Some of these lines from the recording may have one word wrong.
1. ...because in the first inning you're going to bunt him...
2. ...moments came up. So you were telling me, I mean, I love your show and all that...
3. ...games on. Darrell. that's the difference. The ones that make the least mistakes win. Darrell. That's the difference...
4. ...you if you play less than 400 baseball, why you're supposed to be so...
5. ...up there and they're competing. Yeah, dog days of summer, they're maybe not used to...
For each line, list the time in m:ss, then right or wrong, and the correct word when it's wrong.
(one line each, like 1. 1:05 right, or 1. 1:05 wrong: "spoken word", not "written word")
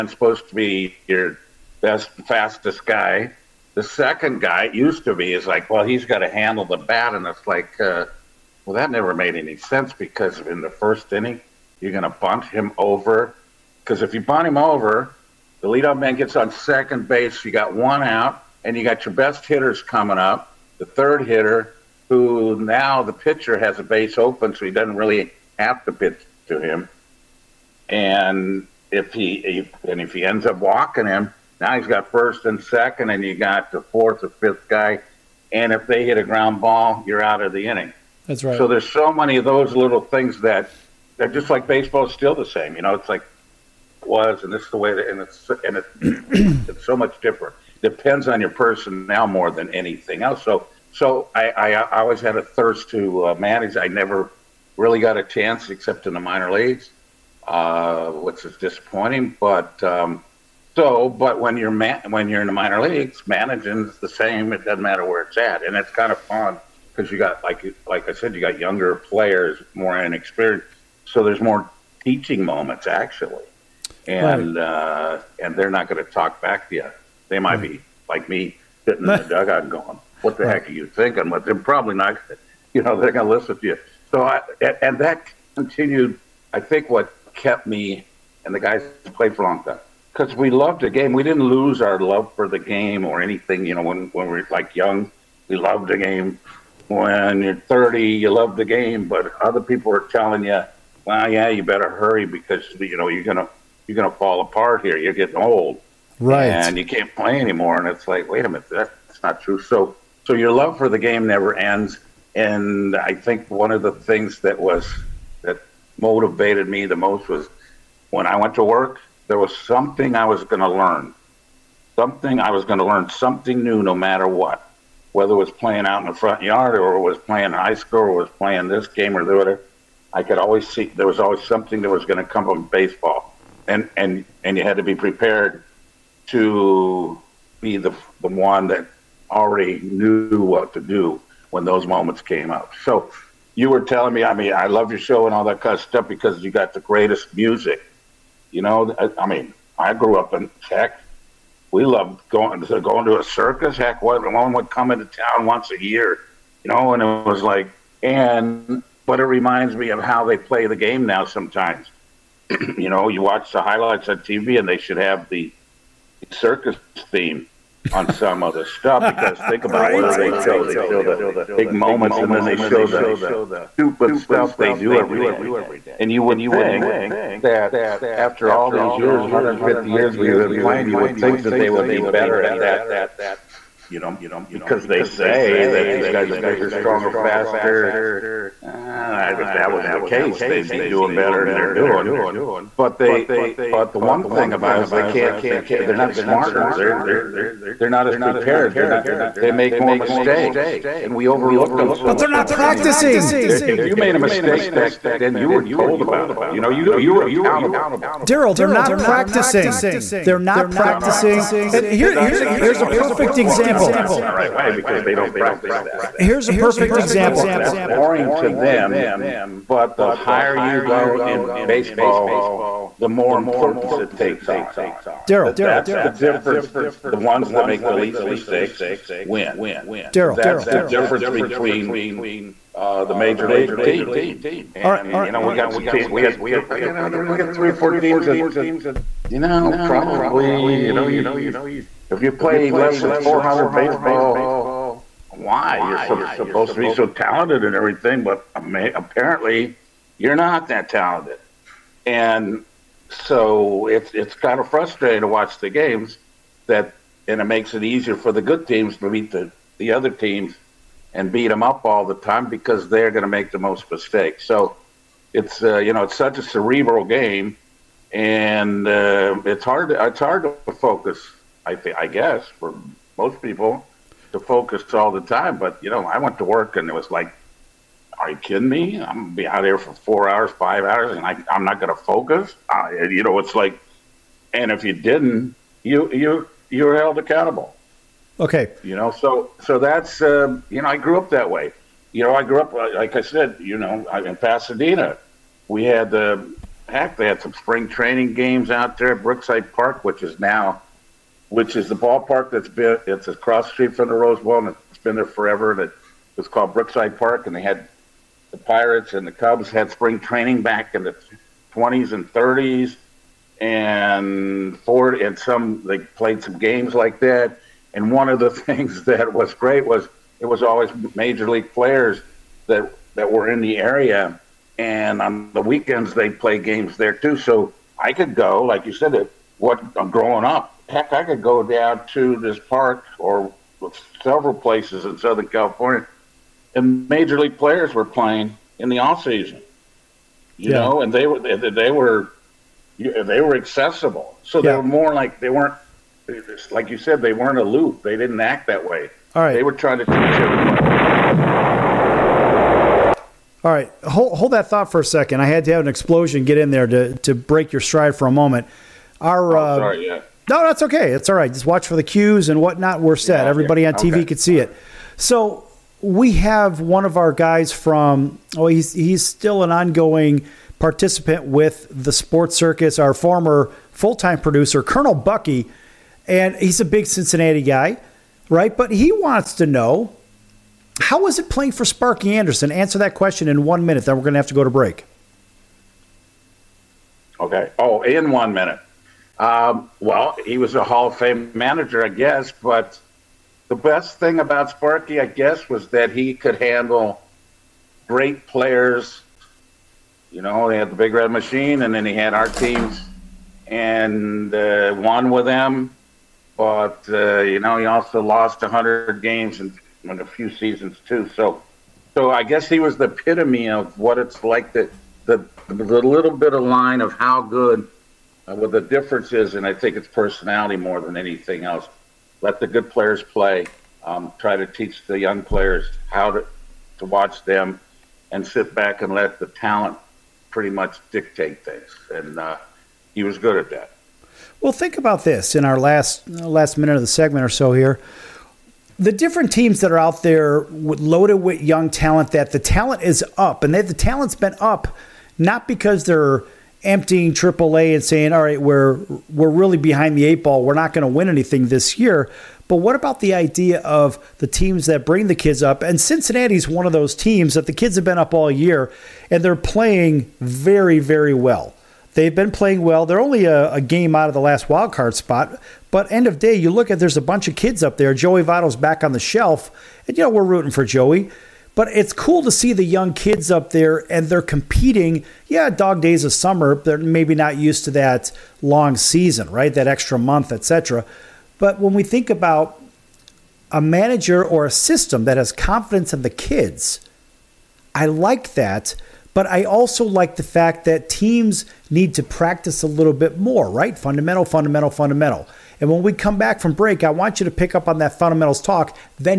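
1. 0:09 right
2. 2:21 right
3. 3:44 wrong: "takes", not "games"
4. 4:01 right
5. 7:53 right.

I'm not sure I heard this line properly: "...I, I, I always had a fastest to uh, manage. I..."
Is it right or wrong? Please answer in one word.
wrong.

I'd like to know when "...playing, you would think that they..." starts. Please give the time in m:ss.
3:00.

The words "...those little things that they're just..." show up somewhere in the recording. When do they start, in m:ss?
0:39.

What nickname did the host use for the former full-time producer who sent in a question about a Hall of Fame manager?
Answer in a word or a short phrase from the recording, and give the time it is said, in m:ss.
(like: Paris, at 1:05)
Colonel Bucky, at 6:14.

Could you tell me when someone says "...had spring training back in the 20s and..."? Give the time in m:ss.
5:09.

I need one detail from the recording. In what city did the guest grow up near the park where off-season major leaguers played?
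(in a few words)
Pasadena.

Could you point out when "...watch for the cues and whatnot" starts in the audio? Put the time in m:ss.
6:01.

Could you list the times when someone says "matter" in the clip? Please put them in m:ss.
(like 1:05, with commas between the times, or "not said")
1:04, 2:03.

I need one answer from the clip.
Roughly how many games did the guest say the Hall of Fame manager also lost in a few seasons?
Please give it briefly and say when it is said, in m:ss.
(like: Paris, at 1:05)
100, at 6:48.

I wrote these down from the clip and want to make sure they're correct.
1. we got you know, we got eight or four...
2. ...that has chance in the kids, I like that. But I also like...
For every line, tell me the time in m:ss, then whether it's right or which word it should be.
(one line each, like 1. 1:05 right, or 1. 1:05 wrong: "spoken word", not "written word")
1. 3:56 wrong: "three", not "eight"
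2. 8:05 wrong: "confidence", not "chance".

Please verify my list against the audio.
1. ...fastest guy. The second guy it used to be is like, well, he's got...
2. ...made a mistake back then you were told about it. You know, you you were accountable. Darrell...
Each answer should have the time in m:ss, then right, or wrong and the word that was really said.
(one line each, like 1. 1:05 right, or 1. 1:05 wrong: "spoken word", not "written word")
1. 0:02 right
2. 3:23 right.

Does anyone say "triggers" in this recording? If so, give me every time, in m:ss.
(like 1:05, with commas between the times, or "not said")
not said.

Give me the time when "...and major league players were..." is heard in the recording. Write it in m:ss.
5:36.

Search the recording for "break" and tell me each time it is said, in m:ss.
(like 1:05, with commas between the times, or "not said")
5:57, 6:24, 8:16.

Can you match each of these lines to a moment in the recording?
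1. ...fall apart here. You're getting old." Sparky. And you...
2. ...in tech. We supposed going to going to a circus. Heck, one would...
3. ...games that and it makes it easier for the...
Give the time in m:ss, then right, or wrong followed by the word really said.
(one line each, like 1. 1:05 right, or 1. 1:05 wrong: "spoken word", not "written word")
1. 1:44 wrong: "Right", not "Sparky"
2. 2:30 wrong: "loved", not "supposed"
3. 4:15 right.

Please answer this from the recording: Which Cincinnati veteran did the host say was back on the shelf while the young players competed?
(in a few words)
Joey Votto.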